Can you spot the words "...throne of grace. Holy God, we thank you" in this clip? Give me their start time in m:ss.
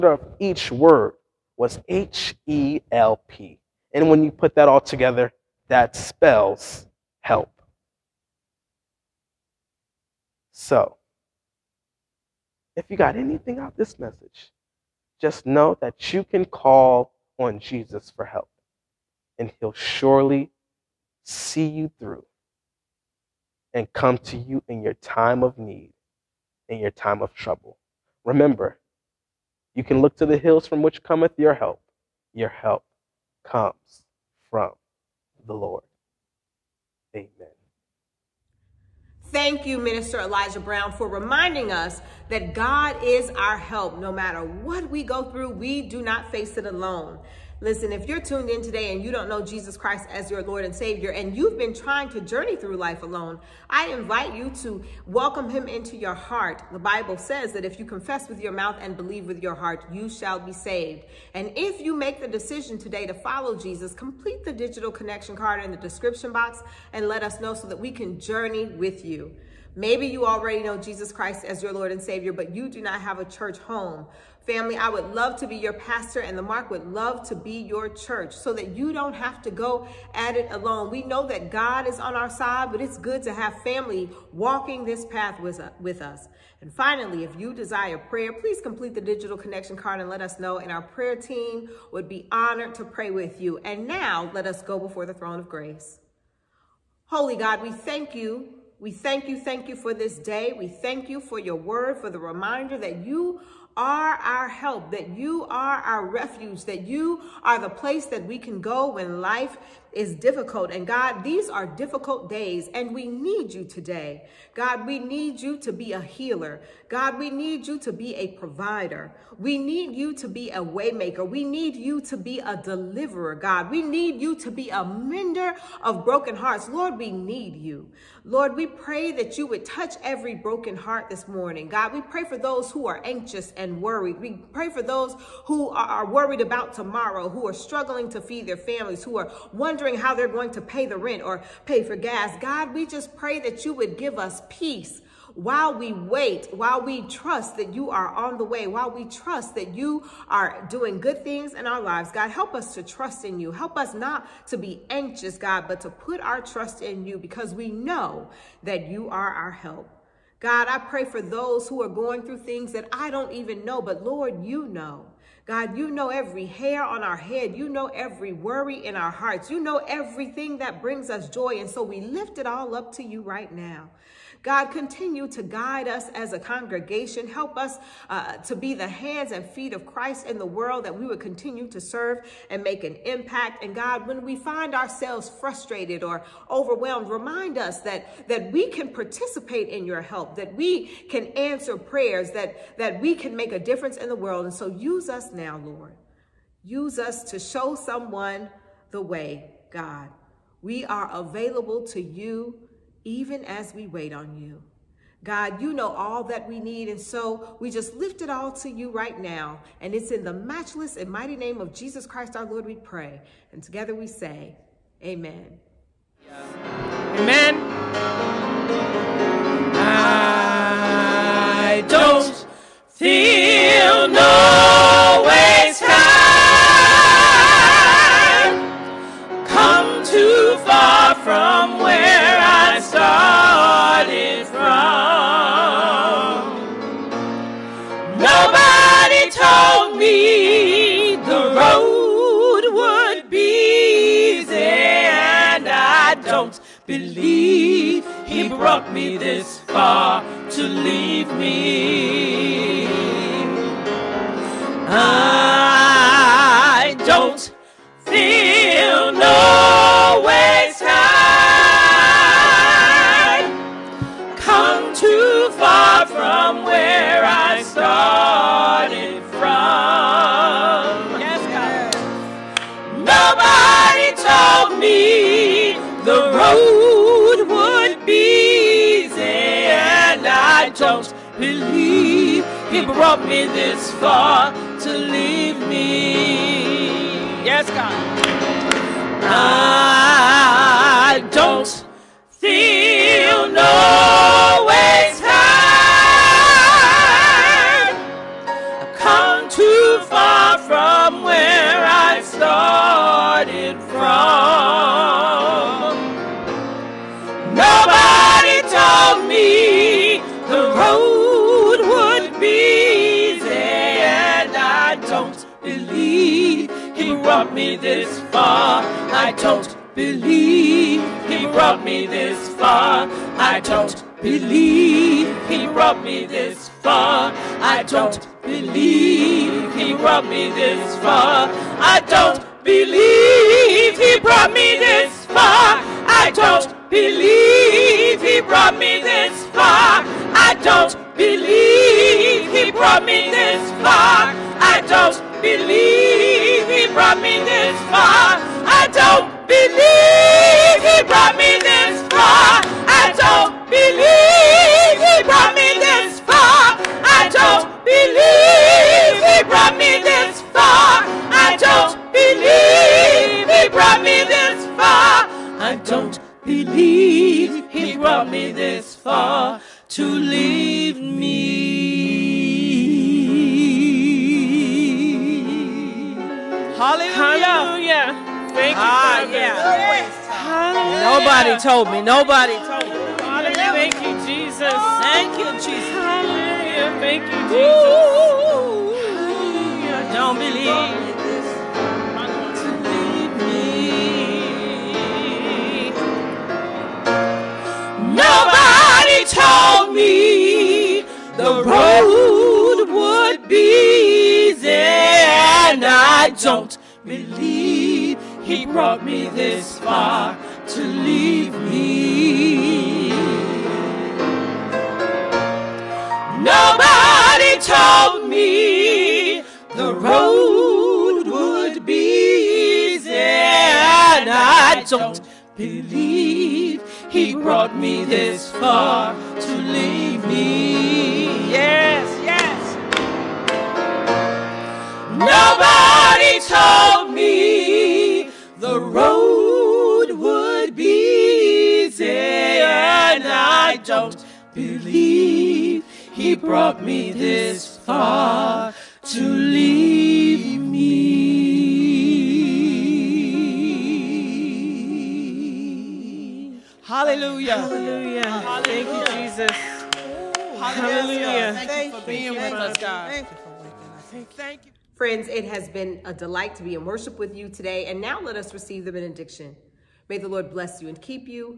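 1:35.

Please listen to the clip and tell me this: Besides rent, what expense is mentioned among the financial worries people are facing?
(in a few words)
Gas.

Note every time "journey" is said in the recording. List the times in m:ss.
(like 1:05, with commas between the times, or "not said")
0:52, 1:08.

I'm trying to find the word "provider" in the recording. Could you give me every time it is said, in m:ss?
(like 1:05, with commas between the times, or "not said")
1:58.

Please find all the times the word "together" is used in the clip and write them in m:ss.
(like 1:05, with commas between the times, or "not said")
0:04, 3:33.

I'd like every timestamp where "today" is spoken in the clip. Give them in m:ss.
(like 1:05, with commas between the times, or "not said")
0:48, 1:02, 1:53, 7:47.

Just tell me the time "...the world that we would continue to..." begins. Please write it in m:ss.
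3:00.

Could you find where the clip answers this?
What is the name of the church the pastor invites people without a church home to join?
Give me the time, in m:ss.
1:16.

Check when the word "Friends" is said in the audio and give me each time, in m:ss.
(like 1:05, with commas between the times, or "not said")
7:44.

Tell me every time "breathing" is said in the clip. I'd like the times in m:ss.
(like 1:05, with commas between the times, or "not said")
not said.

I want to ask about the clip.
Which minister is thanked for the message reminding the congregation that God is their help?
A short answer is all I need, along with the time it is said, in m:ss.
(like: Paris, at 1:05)
Elijah Brown, at 0:39.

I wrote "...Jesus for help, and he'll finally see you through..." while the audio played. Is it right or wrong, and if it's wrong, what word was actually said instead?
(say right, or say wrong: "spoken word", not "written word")
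wrong: "surely", not "finally".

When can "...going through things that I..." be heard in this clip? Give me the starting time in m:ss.
2:41.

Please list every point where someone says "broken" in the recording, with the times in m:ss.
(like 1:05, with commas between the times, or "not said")
2:06, 2:10.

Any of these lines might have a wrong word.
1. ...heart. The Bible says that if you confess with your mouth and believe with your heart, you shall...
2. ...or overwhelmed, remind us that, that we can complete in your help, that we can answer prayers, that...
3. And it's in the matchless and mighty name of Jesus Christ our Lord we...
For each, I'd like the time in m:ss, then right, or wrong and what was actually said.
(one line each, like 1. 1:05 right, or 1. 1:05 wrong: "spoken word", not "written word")
1. 0:56 right
2. 3:06 wrong: "participate", not "complete"
3. 3:29 right.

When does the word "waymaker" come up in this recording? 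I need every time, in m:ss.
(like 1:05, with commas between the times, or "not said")
2:00.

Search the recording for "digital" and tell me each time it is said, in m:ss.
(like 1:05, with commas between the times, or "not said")
1:04, 1:29.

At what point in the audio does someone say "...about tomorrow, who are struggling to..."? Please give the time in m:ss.
2:16.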